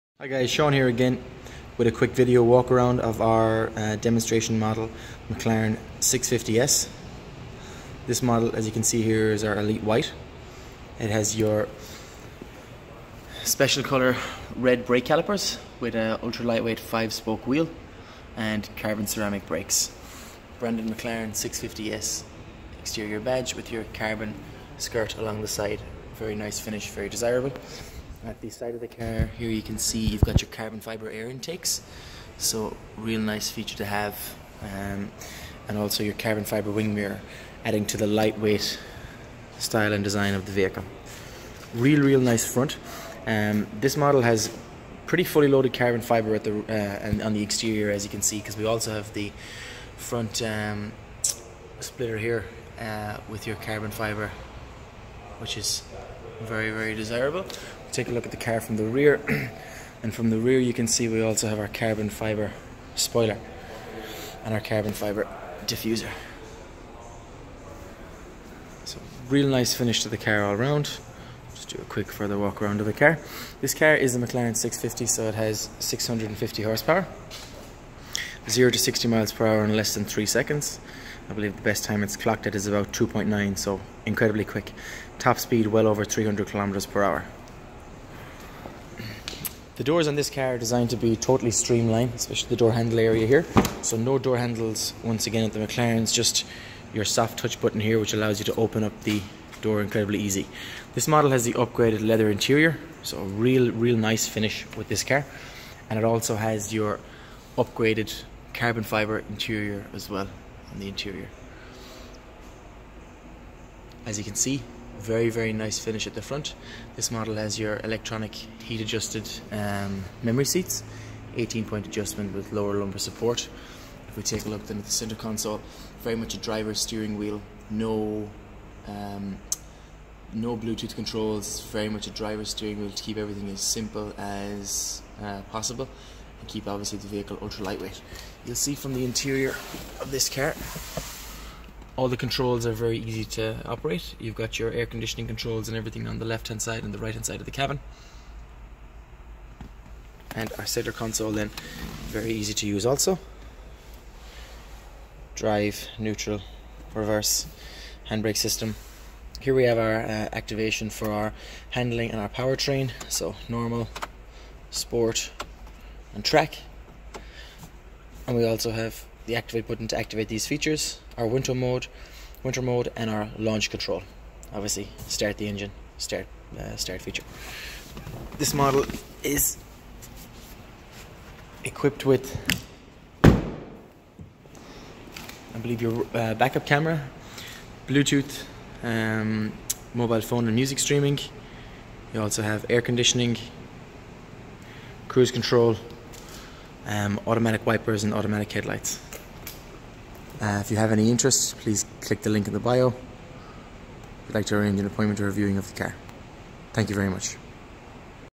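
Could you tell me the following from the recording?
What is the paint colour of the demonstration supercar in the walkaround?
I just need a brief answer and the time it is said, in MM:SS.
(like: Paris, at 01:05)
Elite White, at 00:09.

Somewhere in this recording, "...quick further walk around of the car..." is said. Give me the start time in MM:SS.
01:11.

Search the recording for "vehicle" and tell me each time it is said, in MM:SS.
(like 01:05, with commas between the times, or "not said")
00:40, 02:17.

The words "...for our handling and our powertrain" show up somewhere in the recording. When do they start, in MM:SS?
02:40.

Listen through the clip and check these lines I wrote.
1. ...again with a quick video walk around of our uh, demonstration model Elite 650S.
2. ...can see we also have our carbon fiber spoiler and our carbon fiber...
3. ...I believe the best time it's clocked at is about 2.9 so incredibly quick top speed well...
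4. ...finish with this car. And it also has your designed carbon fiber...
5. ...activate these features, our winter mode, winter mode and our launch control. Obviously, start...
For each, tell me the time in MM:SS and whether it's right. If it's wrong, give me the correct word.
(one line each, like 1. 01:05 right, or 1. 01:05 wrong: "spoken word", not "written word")
1. 00:00 wrong: "McLaren", not "Elite"
2. 01:00 right
3. 01:21 right
4. 01:44 wrong: "upgraded", not "designed"
5. 02:49 right.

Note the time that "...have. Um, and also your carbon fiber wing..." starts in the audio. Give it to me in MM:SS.
00:33.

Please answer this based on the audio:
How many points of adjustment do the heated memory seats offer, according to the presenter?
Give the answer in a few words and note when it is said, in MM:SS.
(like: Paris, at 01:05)
18, at 02:01.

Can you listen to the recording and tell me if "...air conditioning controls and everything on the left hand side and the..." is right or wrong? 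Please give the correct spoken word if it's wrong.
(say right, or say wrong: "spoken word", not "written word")
right.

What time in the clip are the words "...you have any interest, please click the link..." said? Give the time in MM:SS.
03:20.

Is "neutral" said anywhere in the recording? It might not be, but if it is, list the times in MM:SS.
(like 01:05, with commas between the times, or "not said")
02:35.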